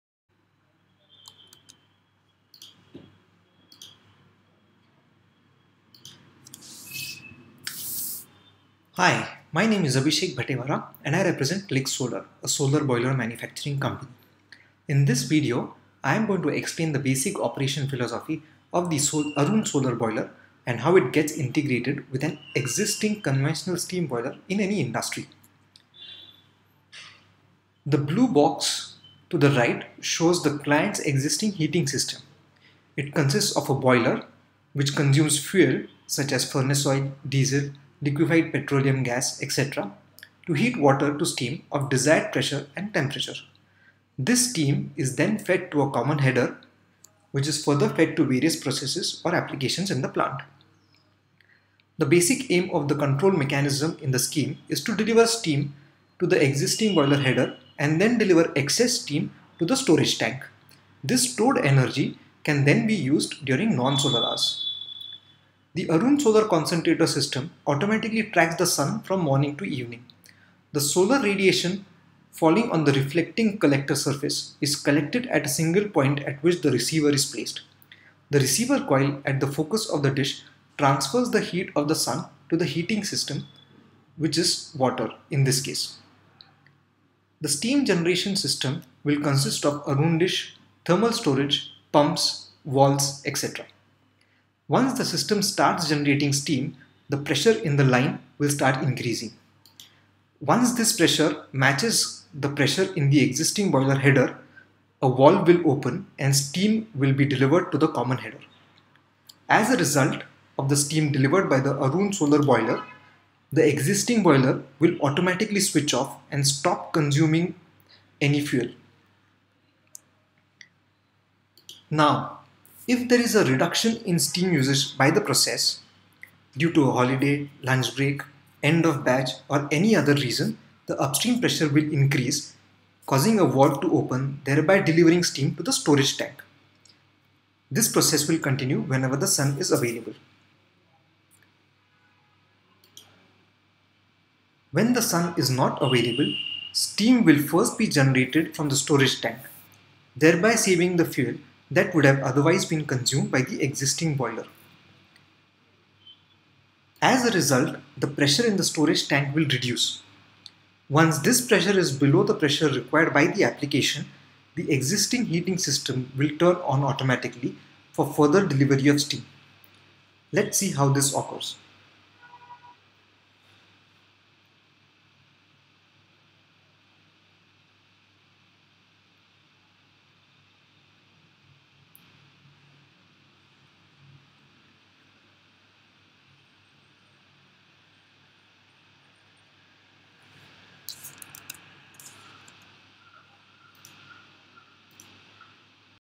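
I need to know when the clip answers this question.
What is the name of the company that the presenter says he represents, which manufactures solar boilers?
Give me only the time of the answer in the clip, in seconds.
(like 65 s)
11 s.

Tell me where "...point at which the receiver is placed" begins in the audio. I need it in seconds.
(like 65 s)
75 s.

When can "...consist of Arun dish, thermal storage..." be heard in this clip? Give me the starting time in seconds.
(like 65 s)
89 s.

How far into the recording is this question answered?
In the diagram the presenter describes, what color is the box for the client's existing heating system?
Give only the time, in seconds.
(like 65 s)
27 s.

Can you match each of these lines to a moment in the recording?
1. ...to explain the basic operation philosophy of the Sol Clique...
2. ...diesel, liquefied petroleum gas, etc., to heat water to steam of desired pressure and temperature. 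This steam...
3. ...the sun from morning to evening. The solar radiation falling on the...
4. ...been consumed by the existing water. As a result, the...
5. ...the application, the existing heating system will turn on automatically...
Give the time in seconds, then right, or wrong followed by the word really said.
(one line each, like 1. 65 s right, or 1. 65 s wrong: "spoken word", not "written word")
1. 16 s wrong: "Arun", not "Clique"
2. 37 s right
3. 68 s right
4. 152 s wrong: "boiler", not "water"
5. 163 s right.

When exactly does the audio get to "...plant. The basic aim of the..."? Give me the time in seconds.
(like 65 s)
50 s.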